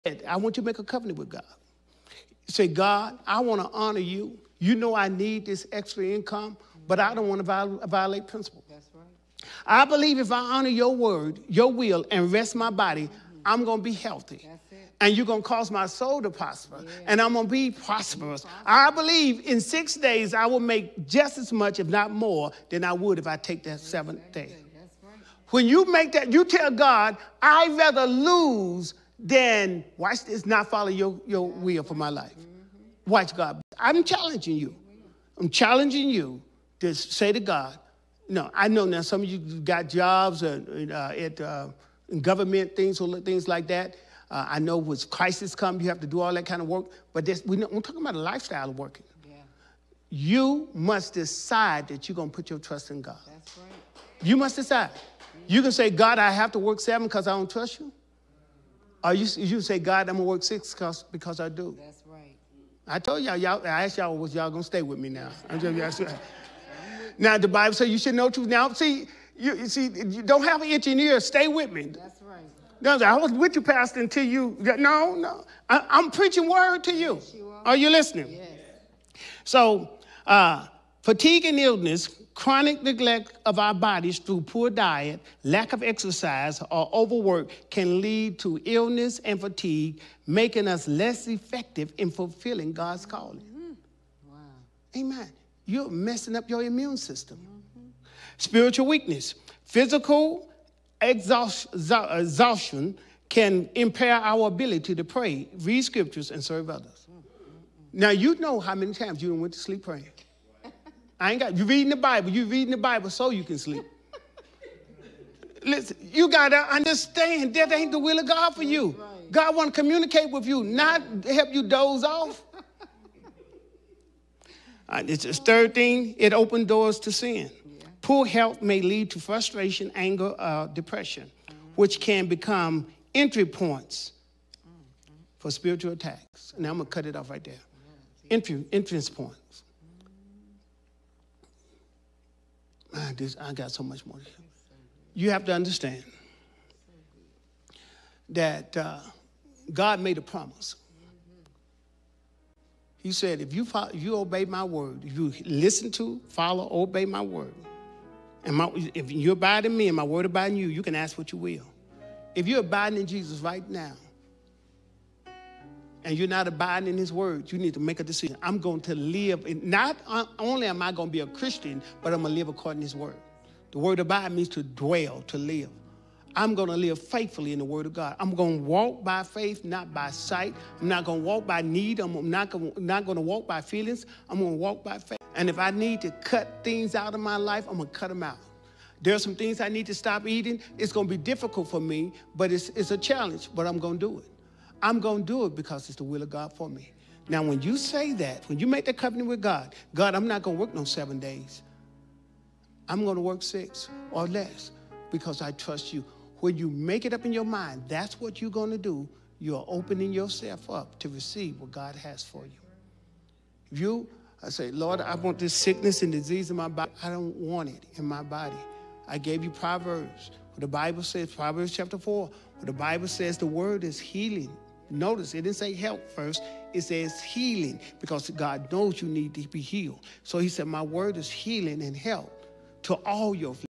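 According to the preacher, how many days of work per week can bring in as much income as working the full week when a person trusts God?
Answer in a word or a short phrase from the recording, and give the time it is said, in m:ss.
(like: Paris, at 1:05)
6, at 0:19.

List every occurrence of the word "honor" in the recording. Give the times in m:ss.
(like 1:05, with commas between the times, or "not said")
0:03, 0:10.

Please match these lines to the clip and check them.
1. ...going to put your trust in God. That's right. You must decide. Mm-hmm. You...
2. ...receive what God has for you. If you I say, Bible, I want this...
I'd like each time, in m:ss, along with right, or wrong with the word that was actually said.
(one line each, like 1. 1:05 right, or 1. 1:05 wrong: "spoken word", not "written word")
1. 0:52 right
2. 3:31 wrong: "Lord", not "Bible".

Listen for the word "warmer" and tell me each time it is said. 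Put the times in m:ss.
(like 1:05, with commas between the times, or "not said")
not said.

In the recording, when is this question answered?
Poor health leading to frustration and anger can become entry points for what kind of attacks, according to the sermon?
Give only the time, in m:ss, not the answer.
2:15.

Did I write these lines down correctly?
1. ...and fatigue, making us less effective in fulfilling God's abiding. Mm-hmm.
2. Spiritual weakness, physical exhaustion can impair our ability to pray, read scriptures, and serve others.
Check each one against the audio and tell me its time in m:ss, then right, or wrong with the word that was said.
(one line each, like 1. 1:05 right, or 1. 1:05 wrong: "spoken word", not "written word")
1. 1:29 wrong: "calling", not "abiding"
2. 1:38 right.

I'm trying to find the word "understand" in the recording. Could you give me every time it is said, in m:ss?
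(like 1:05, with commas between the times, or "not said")
1:56, 2:25.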